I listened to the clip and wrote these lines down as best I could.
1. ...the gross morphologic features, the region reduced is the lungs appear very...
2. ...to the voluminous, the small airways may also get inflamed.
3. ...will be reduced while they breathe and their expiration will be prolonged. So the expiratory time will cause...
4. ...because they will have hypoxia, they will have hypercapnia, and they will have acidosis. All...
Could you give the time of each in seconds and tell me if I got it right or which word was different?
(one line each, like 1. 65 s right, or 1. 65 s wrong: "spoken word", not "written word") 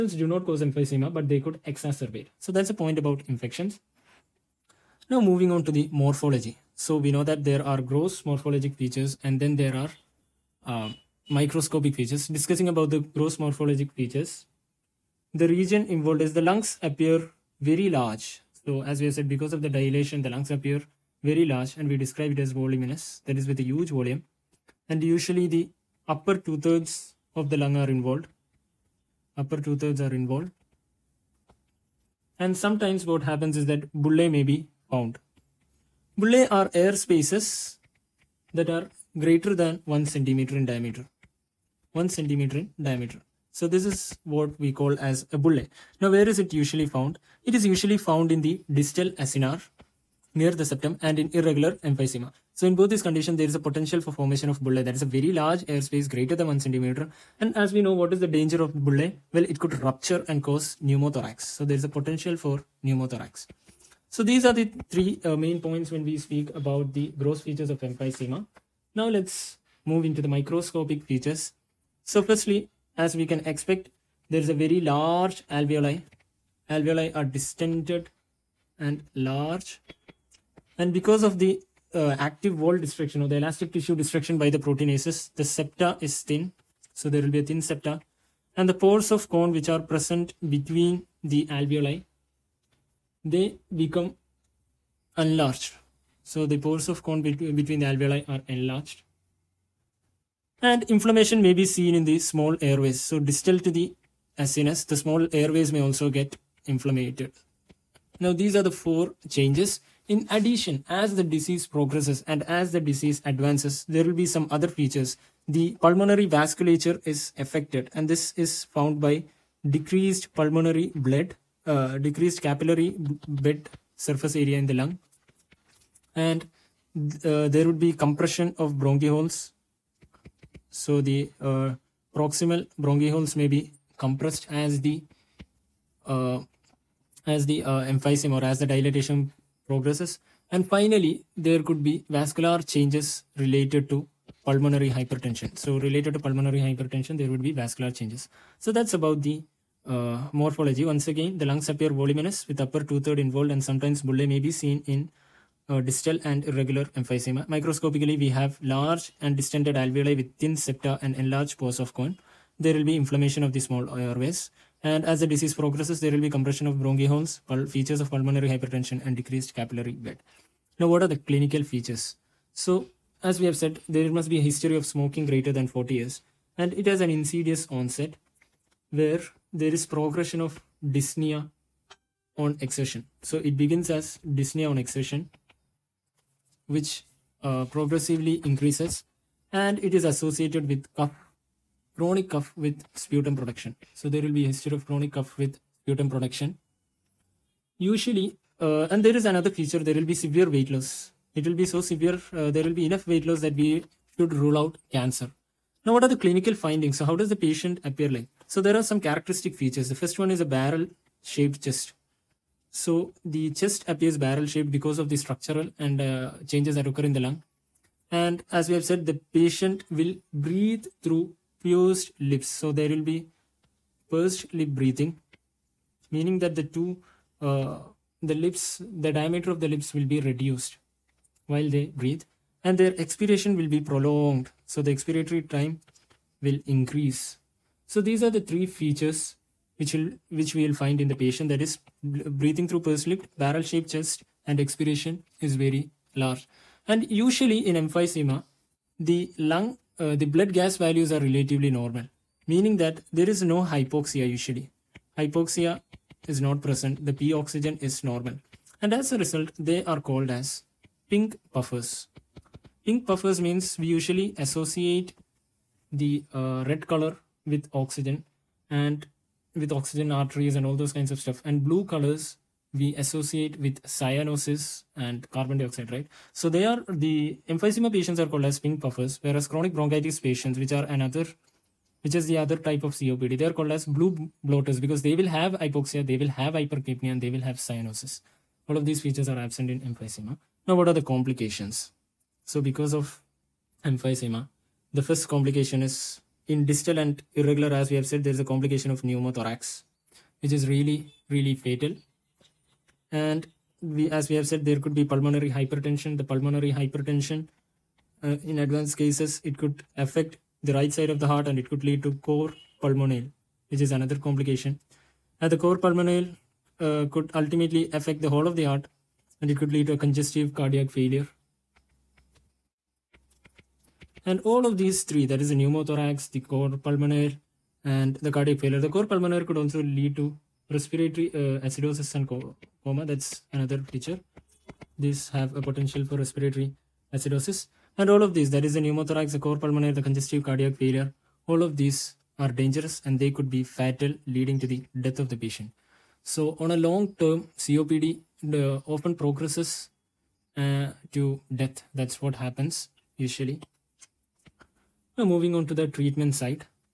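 1. 12 s wrong: "involved", not "reduced"
2. 103 s wrong: "acinus", not "voluminous"
3. 229 s wrong: "increase", not "cause"
4. 284 s wrong: "cyanosis", not "acidosis".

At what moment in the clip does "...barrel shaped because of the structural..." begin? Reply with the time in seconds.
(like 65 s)
214 s.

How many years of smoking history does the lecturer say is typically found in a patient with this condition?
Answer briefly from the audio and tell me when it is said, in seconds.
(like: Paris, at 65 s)
More than 40 years, at 175 s.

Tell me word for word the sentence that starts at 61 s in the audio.
So there is a potential for pneumothorax.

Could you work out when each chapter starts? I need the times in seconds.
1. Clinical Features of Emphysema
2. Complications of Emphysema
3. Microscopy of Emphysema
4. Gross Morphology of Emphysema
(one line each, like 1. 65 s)
1. 170 s
2. 291 s
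3. 70 s
4. 11 s.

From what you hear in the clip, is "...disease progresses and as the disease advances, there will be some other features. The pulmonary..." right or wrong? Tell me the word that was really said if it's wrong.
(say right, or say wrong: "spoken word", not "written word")
right.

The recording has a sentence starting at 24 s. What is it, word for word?
And usually the upper two thirds of the lung are involved.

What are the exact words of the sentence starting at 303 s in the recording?
And we, as we have said, there could be pulmonary hypertension.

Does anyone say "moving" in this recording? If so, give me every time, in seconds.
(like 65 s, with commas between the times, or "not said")
5 s, 355 s.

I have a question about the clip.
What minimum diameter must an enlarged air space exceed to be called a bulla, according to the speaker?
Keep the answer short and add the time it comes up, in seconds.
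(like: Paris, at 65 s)
1 centimeter, at 39 s.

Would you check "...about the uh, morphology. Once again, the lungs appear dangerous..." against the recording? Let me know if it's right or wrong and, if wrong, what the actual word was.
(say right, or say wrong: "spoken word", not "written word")
wrong: "voluminous", not "dangerous".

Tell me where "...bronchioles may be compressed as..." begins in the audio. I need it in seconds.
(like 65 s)
132 s.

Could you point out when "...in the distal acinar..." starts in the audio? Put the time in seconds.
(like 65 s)
48 s.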